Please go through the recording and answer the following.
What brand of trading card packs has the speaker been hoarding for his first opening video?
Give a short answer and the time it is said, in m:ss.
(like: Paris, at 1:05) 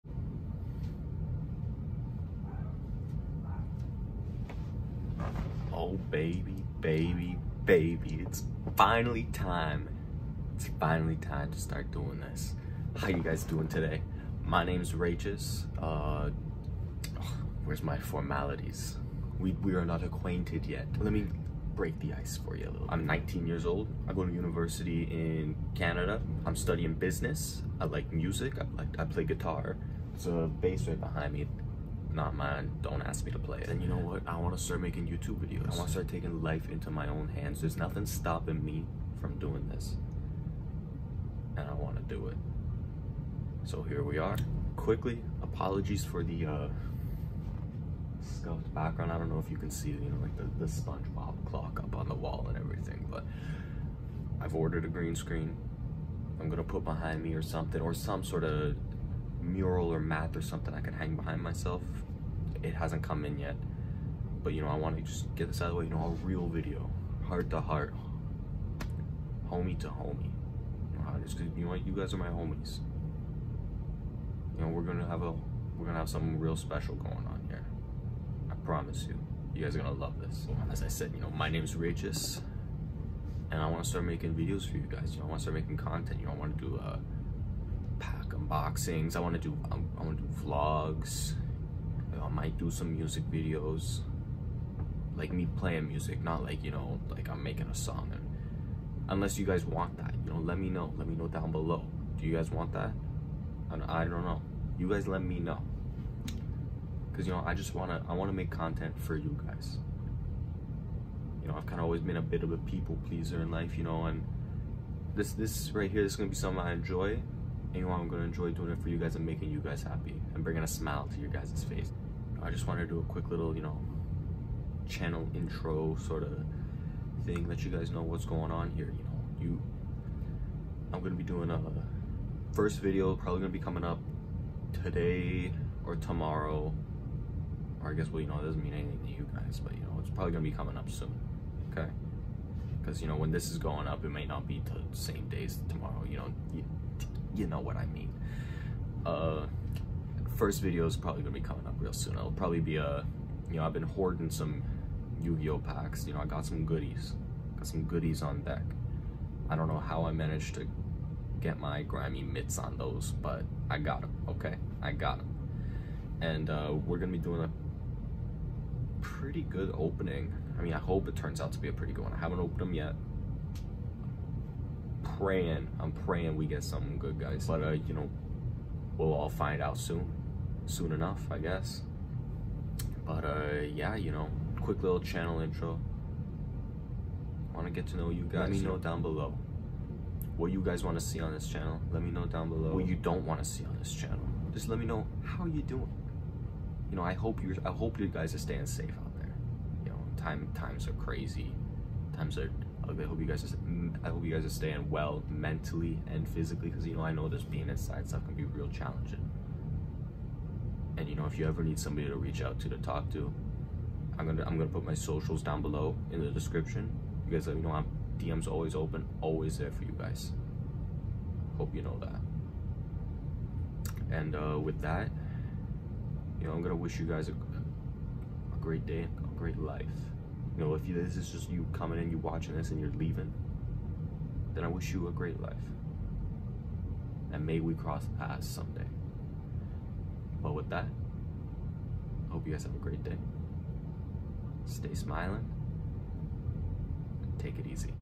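Yu-Gi-Oh, at 2:35.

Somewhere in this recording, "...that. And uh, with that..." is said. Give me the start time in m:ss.
3:41.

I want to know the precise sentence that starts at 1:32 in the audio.
I might do some music videos, like me playing music, not like you know like I'm making a song.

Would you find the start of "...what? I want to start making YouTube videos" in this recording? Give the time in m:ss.
0:33.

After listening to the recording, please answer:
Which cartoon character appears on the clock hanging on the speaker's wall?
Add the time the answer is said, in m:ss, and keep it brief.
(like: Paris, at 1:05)
SpongeBob, at 0:50.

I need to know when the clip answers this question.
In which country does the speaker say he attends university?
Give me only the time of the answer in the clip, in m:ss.
0:25.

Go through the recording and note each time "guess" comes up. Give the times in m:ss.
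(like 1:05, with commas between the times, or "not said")
2:17, 3:01.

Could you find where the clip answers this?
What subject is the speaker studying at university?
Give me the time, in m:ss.
0:26.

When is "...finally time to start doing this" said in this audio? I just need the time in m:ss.
0:10.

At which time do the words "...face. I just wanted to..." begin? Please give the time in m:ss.
2:01.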